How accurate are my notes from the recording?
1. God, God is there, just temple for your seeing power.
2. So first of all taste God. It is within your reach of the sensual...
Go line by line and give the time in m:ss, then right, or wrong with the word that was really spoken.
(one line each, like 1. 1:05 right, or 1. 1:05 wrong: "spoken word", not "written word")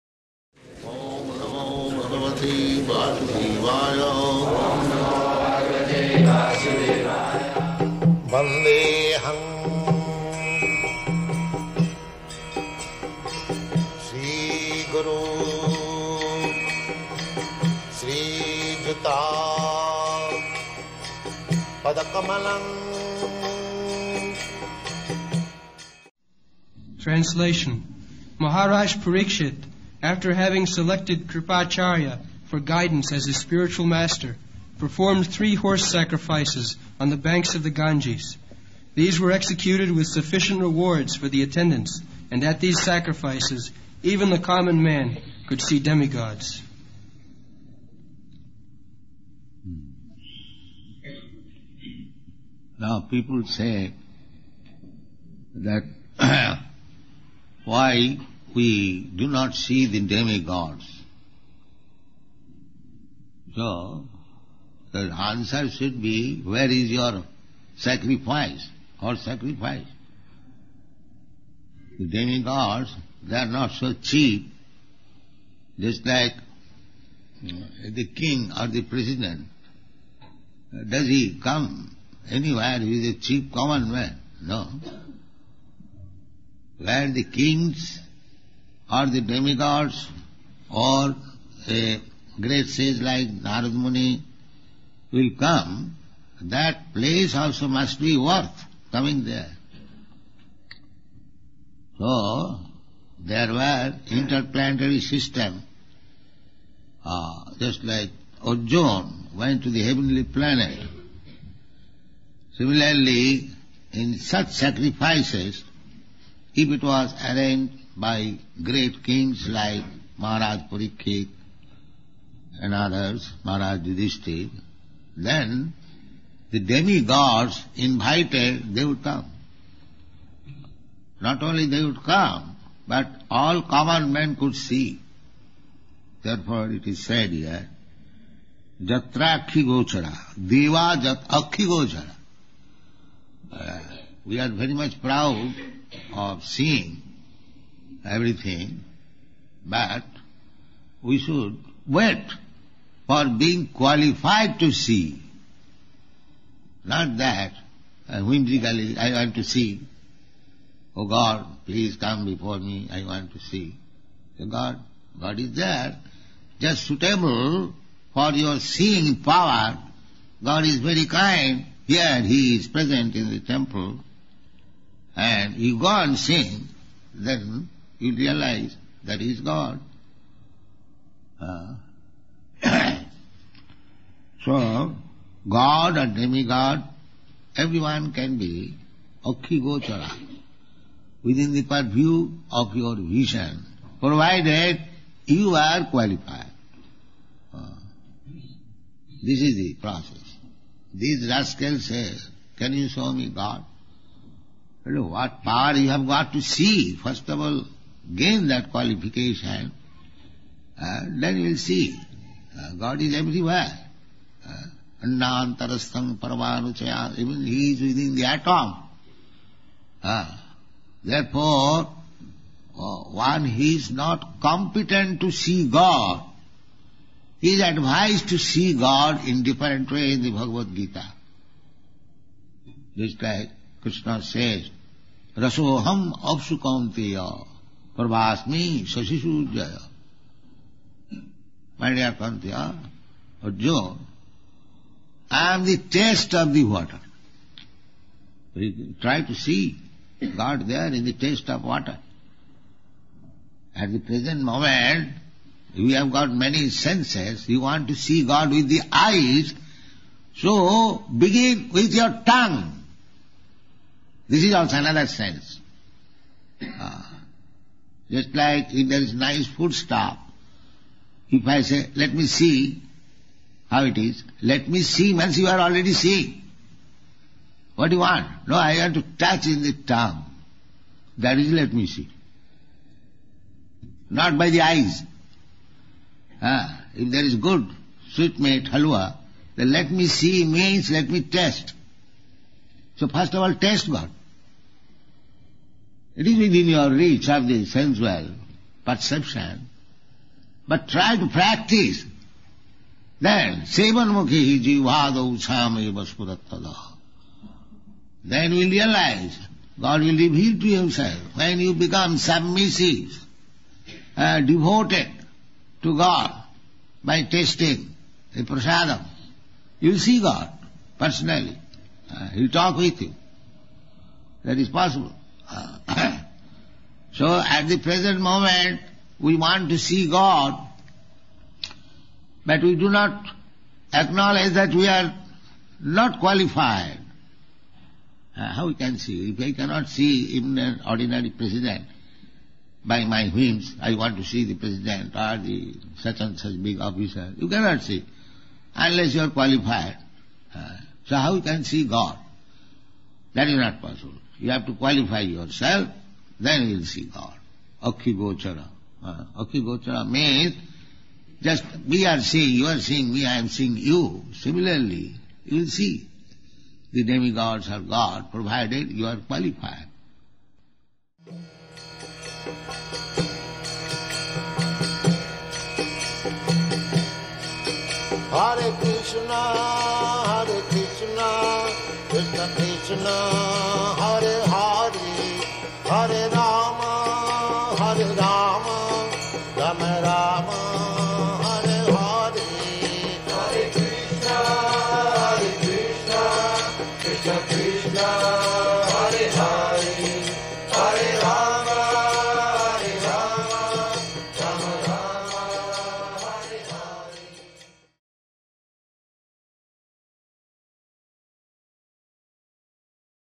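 1. 2:44 wrong: "suitable", not "temple"
2. 4:52 right.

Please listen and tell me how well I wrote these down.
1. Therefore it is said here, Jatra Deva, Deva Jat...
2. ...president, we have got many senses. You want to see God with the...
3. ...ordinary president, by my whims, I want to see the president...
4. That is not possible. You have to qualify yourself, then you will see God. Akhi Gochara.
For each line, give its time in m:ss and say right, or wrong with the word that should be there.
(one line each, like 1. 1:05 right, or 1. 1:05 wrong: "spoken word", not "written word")
1. 2:16 wrong: "Gochara", not "Deva"
2. 4:14 wrong: "moment", not "president"
3. 5:40 right
4. 5:53 right.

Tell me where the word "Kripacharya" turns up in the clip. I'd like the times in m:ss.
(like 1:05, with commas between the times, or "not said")
0:31.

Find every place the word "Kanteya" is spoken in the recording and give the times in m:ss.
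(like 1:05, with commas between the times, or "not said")
4:02.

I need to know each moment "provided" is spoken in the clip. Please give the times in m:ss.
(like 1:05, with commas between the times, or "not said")
3:13, 6:08.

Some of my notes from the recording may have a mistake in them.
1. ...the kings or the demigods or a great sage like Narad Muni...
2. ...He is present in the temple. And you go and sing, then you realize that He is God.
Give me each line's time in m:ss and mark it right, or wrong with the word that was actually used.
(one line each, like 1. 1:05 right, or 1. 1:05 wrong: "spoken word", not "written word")
1. 1:27 right
2. 2:52 right.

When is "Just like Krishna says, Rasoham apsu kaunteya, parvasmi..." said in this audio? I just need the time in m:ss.
3:52.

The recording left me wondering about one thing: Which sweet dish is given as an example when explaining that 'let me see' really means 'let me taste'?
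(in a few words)
Halwa.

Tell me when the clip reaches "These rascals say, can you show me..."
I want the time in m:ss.
3:20.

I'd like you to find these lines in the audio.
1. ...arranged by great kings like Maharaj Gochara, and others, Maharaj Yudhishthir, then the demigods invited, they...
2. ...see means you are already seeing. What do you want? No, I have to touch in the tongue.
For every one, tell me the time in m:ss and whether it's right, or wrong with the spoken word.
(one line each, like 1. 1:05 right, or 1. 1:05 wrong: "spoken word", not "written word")
1. 1:57 wrong: "Parikshit", not "Gochara"
2. 4:34 right.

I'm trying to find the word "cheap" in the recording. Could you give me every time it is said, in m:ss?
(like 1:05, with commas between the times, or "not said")
1:14, 1:23.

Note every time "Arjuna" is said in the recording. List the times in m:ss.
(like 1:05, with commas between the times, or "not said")
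1:48, 4:03.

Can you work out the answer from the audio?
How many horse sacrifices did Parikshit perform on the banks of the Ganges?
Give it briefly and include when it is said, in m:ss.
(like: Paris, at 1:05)
3, at 0:35.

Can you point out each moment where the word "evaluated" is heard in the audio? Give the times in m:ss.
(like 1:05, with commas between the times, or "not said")
not said.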